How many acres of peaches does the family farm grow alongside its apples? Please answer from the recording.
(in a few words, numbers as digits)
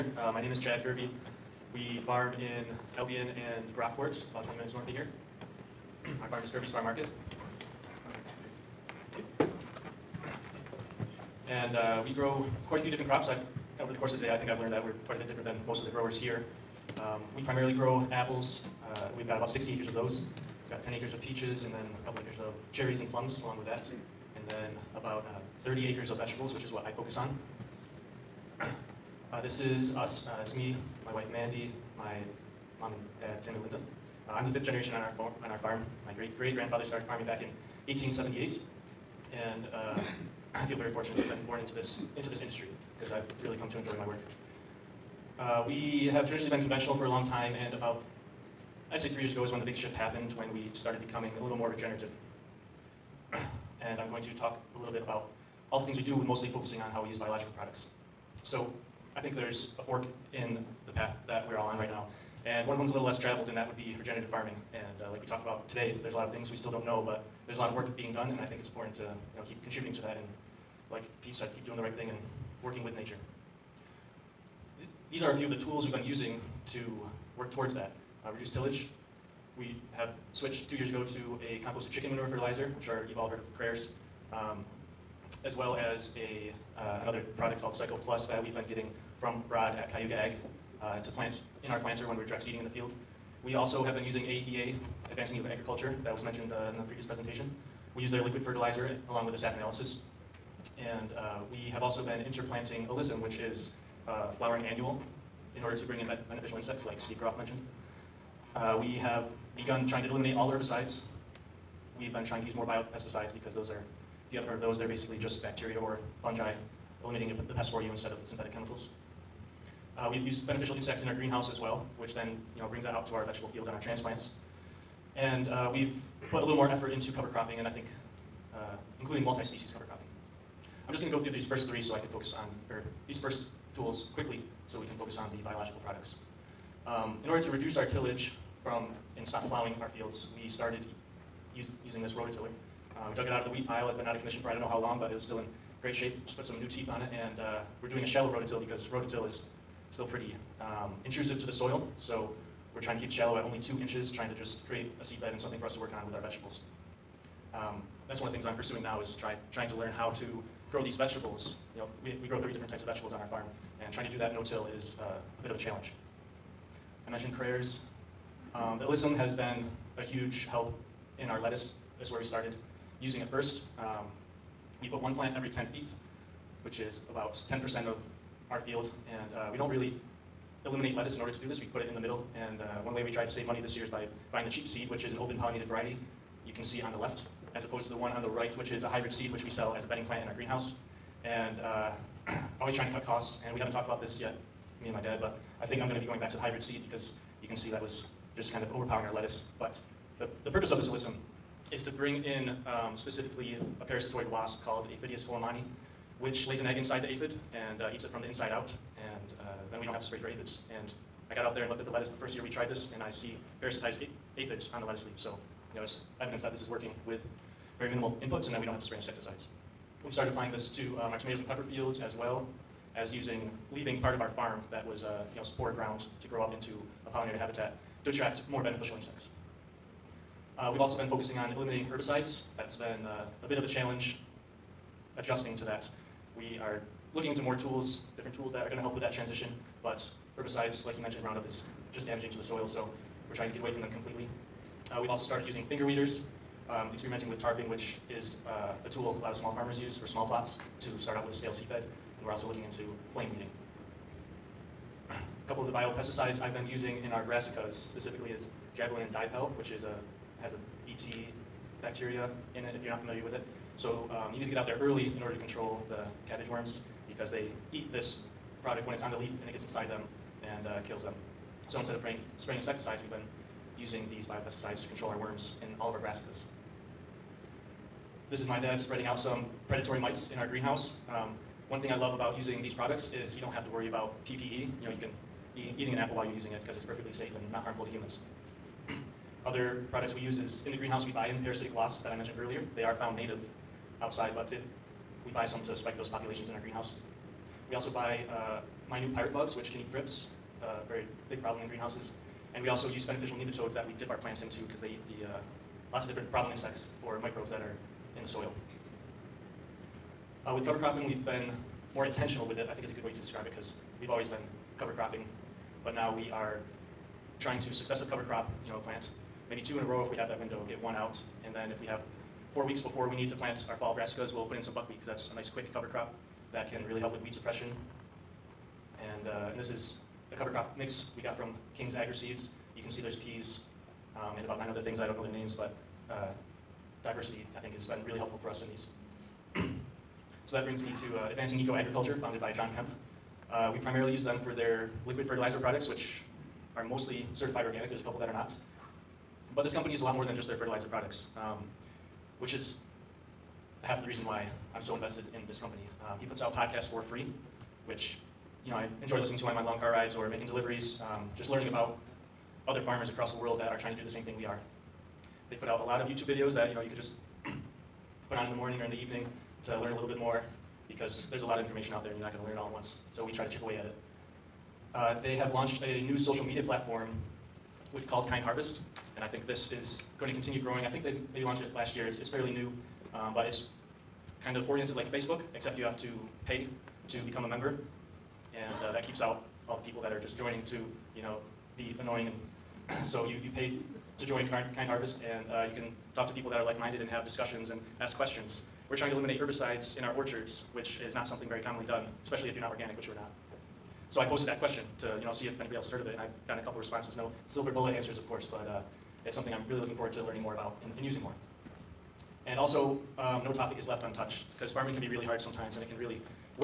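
10 acres.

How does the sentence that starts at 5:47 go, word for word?
There's a couple that are not.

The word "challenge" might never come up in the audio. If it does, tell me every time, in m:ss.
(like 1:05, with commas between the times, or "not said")
2:45, 3:53.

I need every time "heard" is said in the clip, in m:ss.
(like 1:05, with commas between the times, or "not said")
1:23, 1:54, 6:45.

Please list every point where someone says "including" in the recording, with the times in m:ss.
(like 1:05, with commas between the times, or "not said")
2:08.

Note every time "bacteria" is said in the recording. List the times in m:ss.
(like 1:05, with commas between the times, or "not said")
1:55, 4:21.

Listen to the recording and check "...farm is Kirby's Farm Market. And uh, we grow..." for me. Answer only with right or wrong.
right.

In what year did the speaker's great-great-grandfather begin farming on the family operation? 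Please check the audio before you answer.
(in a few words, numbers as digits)
1878.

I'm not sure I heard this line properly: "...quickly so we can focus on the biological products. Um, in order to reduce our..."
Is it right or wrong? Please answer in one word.
right.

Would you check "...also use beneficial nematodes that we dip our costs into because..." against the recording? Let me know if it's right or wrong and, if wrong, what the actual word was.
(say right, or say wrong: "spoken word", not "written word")
wrong: "plants", not "costs".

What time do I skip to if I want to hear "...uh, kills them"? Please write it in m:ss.
4:30.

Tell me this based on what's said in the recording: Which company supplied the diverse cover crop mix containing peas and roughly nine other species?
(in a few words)
King's Agri Seeds.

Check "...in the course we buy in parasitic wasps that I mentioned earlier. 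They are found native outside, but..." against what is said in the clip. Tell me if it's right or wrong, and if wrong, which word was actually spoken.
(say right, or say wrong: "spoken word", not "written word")
wrong: "greenhouse", not "course".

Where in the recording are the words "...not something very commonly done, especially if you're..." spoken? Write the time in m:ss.
6:41.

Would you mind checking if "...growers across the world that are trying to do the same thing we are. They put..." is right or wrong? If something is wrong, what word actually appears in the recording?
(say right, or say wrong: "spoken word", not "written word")
wrong: "farmers", not "growers".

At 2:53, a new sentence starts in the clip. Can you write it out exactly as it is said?
Um, we put one plant every 10 feet, which is about 10% of our field.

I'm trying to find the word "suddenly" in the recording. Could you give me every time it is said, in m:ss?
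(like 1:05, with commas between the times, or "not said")
not said.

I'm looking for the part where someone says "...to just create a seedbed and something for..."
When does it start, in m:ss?
2:34.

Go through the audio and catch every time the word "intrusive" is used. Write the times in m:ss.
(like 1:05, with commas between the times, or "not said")
2:31.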